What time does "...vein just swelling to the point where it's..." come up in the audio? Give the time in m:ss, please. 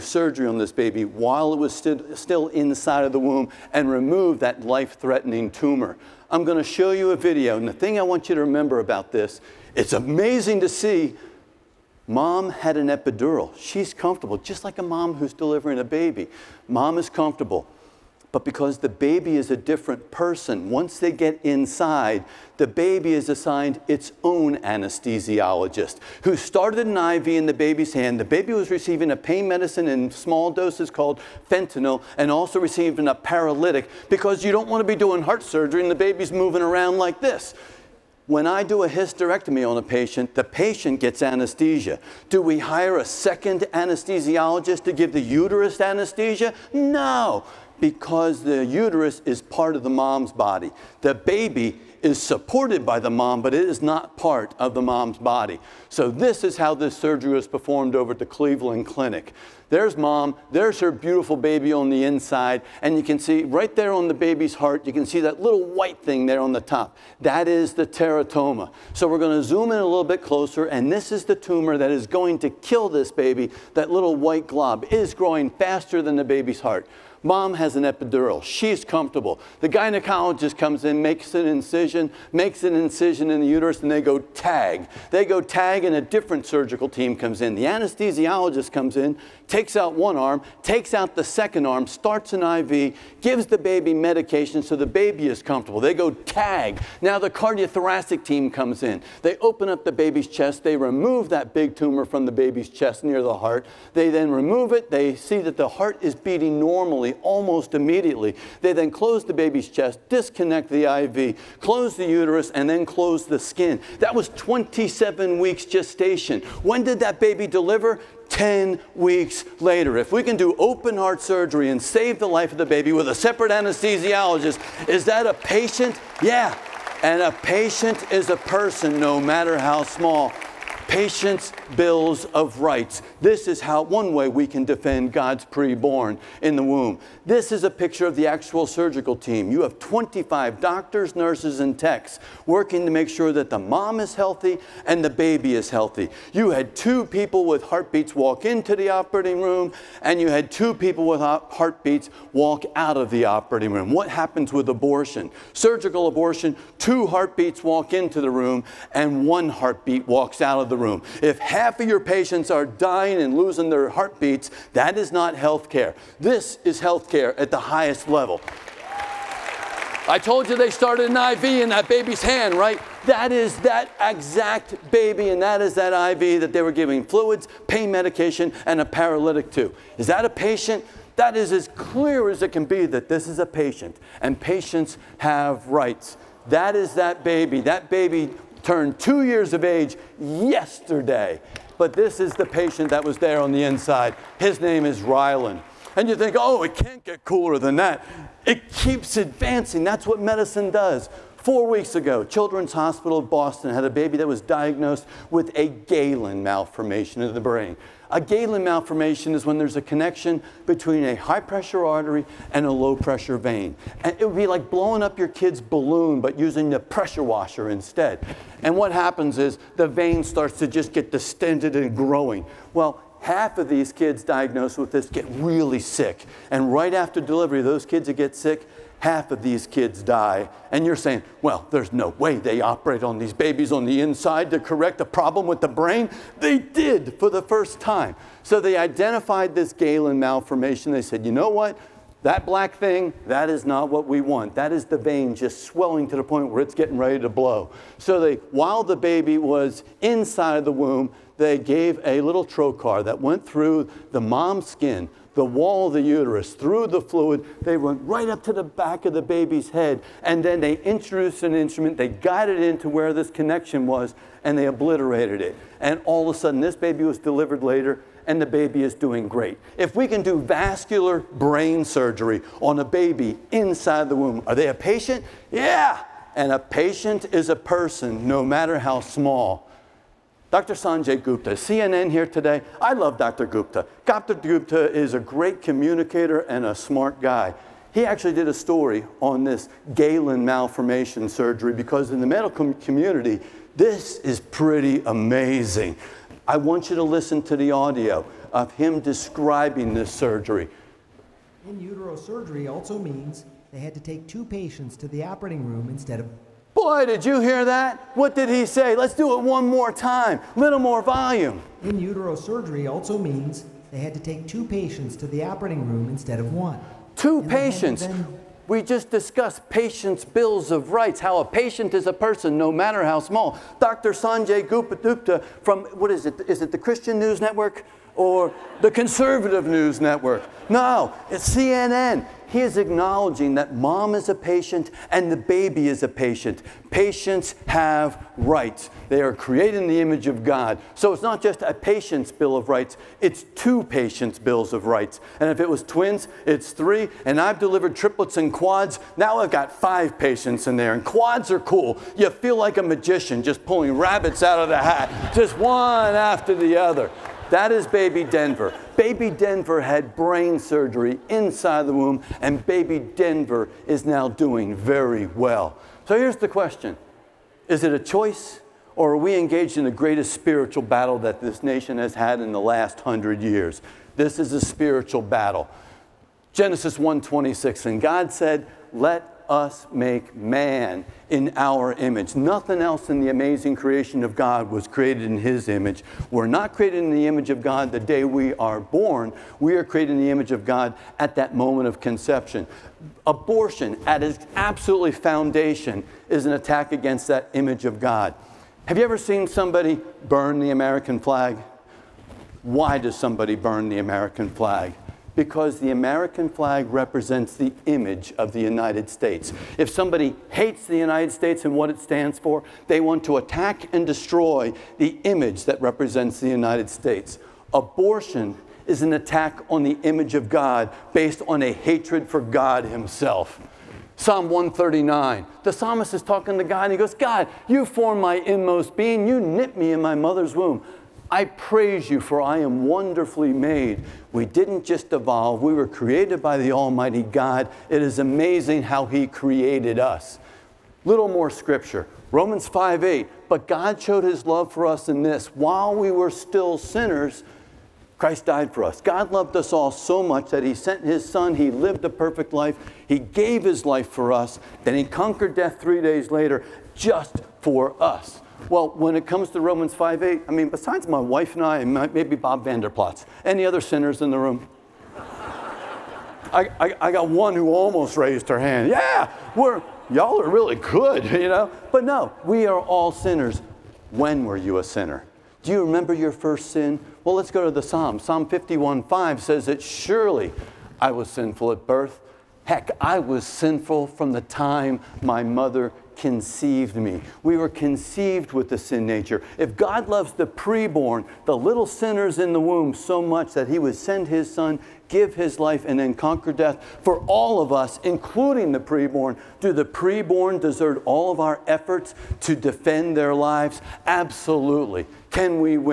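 4:04.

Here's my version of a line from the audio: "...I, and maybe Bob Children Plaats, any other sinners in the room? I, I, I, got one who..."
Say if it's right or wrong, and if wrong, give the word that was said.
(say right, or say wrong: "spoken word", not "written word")
wrong: "Vander", not "Children".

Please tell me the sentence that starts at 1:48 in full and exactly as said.
They then close the baby's chest, disconnect the IV, close close the uterus and then close the skin.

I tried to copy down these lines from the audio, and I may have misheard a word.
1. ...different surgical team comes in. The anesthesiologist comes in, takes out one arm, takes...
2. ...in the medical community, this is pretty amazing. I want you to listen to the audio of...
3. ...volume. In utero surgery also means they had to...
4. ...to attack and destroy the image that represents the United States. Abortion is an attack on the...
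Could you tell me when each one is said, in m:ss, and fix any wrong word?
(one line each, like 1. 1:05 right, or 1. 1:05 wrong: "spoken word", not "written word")
1. 1:26 right
2. 4:52 right
3. 5:11 right
4. 6:53 right.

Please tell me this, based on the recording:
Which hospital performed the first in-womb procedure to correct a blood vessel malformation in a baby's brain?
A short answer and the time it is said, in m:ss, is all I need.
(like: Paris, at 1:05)
Children's Hospital of Boston, at 3:22.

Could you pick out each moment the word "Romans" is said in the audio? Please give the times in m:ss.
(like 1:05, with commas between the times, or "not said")
7:22, 7:39.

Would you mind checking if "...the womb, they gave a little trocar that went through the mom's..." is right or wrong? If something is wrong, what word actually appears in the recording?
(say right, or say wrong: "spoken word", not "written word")
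right.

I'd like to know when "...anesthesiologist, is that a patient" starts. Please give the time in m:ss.
2:03.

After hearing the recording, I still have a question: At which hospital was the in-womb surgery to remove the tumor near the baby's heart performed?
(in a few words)
Cleveland Clinic.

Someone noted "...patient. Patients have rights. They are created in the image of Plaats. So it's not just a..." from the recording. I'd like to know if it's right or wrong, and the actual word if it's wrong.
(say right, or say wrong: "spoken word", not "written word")
wrong: "God", not "Plaats".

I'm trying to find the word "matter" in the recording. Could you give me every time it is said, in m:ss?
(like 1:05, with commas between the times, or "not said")
2:09, 4:38, 5:22.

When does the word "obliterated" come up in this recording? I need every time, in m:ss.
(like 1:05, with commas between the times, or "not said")
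4:24.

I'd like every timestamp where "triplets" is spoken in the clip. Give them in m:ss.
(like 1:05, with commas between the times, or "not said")
5:47.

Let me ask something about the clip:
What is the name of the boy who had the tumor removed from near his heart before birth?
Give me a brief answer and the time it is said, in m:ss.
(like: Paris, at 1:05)
Rylan, at 3:15.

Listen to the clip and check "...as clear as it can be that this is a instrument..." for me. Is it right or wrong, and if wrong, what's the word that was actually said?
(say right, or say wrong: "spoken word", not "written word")
wrong: "patient", not "instrument".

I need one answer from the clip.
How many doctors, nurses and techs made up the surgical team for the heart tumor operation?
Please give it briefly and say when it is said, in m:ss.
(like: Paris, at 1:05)
25, at 2:19.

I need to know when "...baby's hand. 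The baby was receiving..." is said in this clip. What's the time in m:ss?
0:27.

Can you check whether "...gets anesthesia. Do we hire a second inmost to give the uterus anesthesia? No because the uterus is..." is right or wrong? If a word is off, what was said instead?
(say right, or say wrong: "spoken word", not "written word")
wrong: "anesthesiologist", not "inmost".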